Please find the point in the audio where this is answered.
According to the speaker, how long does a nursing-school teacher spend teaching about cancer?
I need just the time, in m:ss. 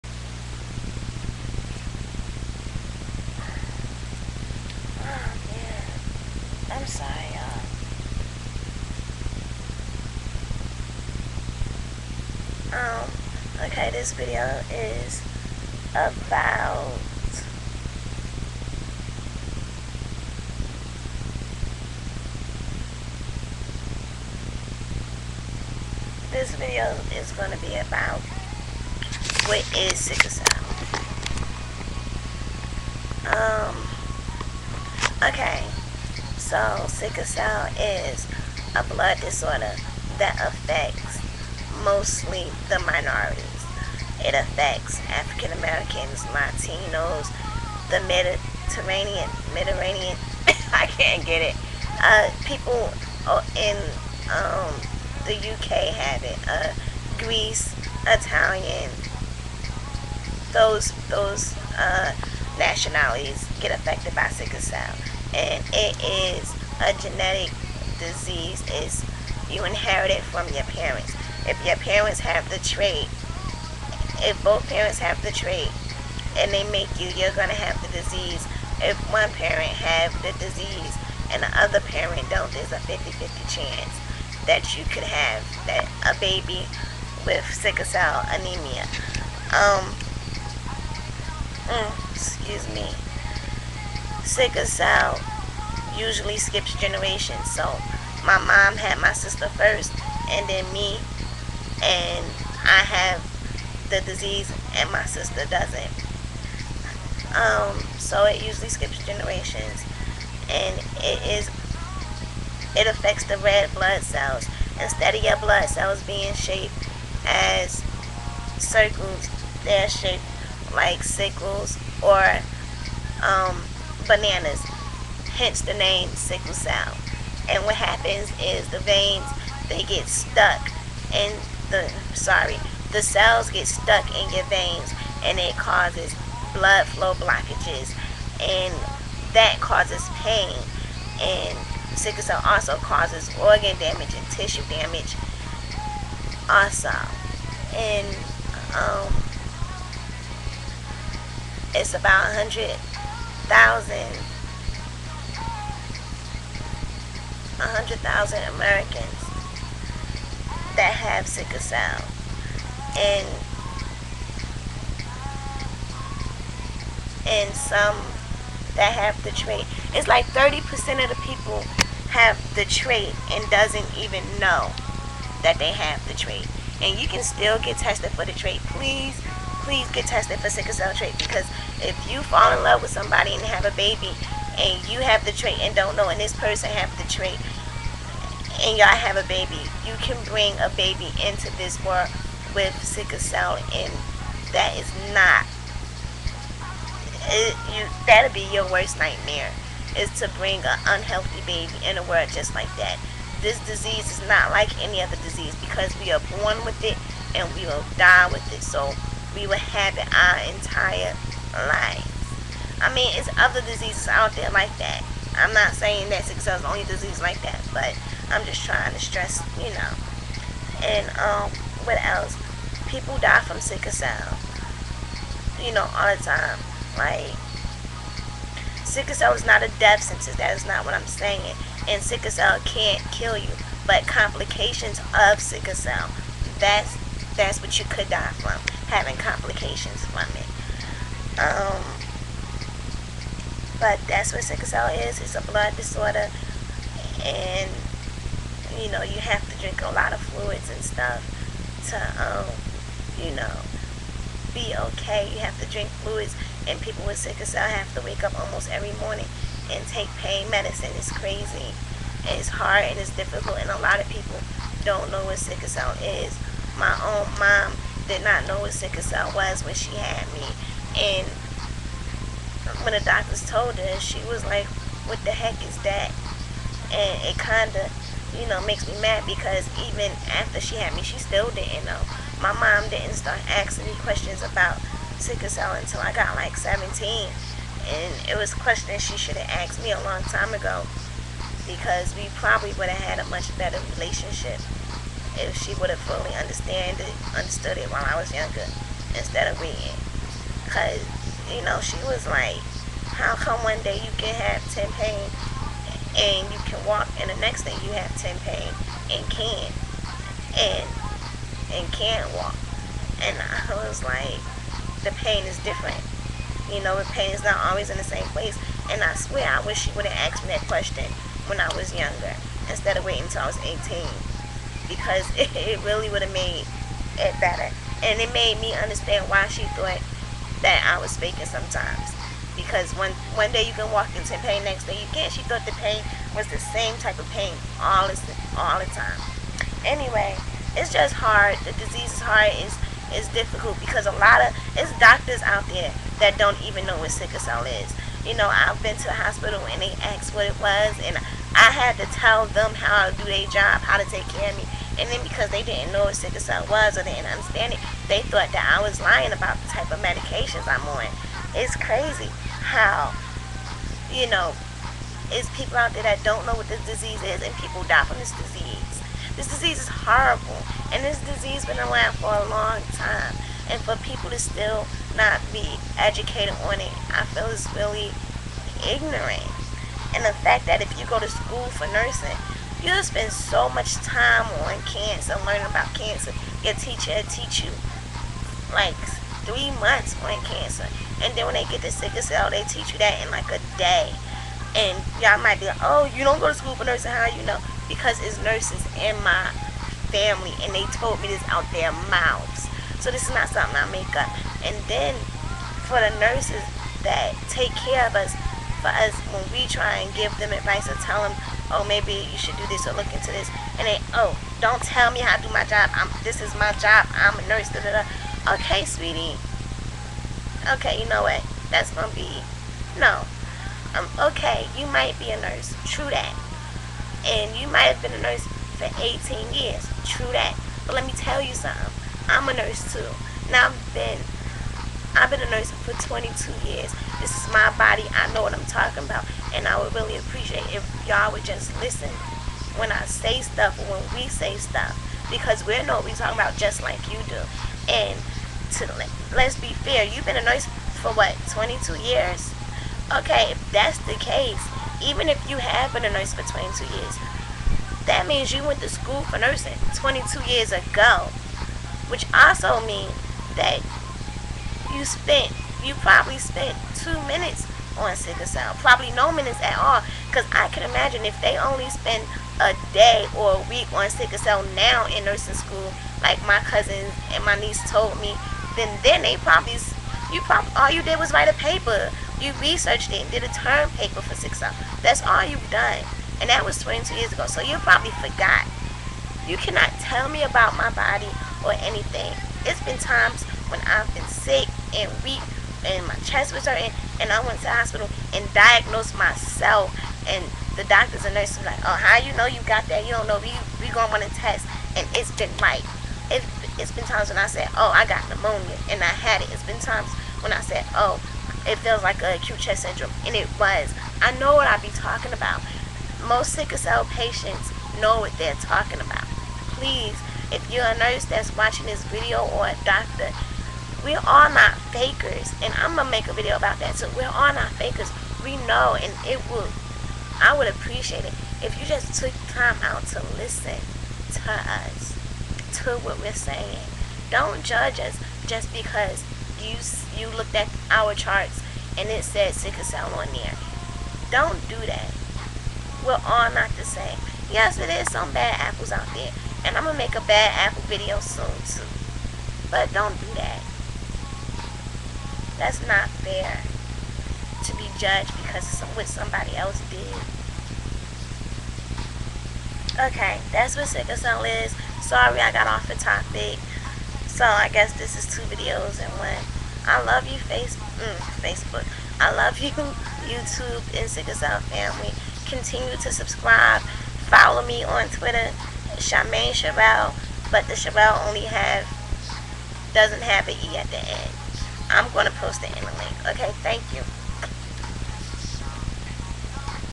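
6:29.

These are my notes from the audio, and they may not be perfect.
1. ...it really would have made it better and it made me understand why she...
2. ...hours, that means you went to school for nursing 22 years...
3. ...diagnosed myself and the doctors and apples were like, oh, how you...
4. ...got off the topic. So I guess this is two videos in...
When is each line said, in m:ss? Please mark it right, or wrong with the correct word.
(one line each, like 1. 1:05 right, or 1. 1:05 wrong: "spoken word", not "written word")
1. 5:25 right
2. 7:36 wrong: "years", not "hours"
3. 8:18 wrong: "nurses", not "apples"
4. 9:25 right.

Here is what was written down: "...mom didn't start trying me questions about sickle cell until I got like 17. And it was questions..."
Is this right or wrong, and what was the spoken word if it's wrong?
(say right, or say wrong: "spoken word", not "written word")
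wrong: "asking", not "trying".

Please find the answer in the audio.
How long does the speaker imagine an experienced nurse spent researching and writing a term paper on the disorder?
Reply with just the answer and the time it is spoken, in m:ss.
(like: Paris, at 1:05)
6 hours, at 8:04.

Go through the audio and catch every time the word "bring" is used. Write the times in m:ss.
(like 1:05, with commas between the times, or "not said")
3:10, 3:20.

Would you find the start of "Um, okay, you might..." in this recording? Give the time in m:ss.
7:03.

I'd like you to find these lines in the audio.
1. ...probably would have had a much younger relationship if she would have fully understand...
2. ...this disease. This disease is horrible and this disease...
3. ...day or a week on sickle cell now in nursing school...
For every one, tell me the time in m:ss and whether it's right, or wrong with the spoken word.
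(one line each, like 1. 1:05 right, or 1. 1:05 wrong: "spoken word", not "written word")
1. 4:52 wrong: "better", not "younger"
2. 6:08 right
3. 7:52 right.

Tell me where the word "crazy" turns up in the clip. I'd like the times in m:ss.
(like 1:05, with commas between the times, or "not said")
4:21, 6:01.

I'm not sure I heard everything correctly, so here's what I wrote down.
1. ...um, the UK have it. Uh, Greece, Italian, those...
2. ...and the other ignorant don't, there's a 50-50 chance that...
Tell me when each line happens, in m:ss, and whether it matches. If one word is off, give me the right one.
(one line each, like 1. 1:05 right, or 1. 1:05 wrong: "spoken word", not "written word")
1. 0:54 right
2. 1:21 wrong: "parent", not "ignorant".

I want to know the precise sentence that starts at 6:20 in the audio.
And the fact that if you go to school for nursing, you'll spend so much time on cancer, learning about cancer.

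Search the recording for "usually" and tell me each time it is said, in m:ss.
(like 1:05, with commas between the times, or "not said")
1:35, 1:48.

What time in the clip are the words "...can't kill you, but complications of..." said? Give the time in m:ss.
3:52.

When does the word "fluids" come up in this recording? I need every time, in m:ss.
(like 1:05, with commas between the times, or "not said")
4:10, 4:16.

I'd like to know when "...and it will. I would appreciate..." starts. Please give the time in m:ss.
8:48.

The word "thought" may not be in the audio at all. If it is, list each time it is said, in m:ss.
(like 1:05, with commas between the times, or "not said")
5:29, 5:35, 5:58.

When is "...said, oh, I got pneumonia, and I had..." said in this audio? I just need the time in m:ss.
8:27.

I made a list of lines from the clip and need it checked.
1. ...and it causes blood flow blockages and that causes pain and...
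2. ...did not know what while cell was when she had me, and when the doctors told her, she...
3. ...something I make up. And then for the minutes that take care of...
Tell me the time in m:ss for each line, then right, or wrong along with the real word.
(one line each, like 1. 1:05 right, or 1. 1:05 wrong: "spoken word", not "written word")
1. 2:15 right
2. 4:28 wrong: "sickle", not "while"
3. 6:43 wrong: "nurses", not "minutes".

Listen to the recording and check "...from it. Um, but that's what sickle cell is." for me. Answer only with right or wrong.
right.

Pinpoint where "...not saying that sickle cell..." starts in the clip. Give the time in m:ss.
3:35.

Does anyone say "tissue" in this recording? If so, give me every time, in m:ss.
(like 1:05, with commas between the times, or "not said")
2:24.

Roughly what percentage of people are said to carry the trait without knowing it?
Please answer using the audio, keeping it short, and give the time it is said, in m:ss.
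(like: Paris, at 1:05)
30%, at 2:50.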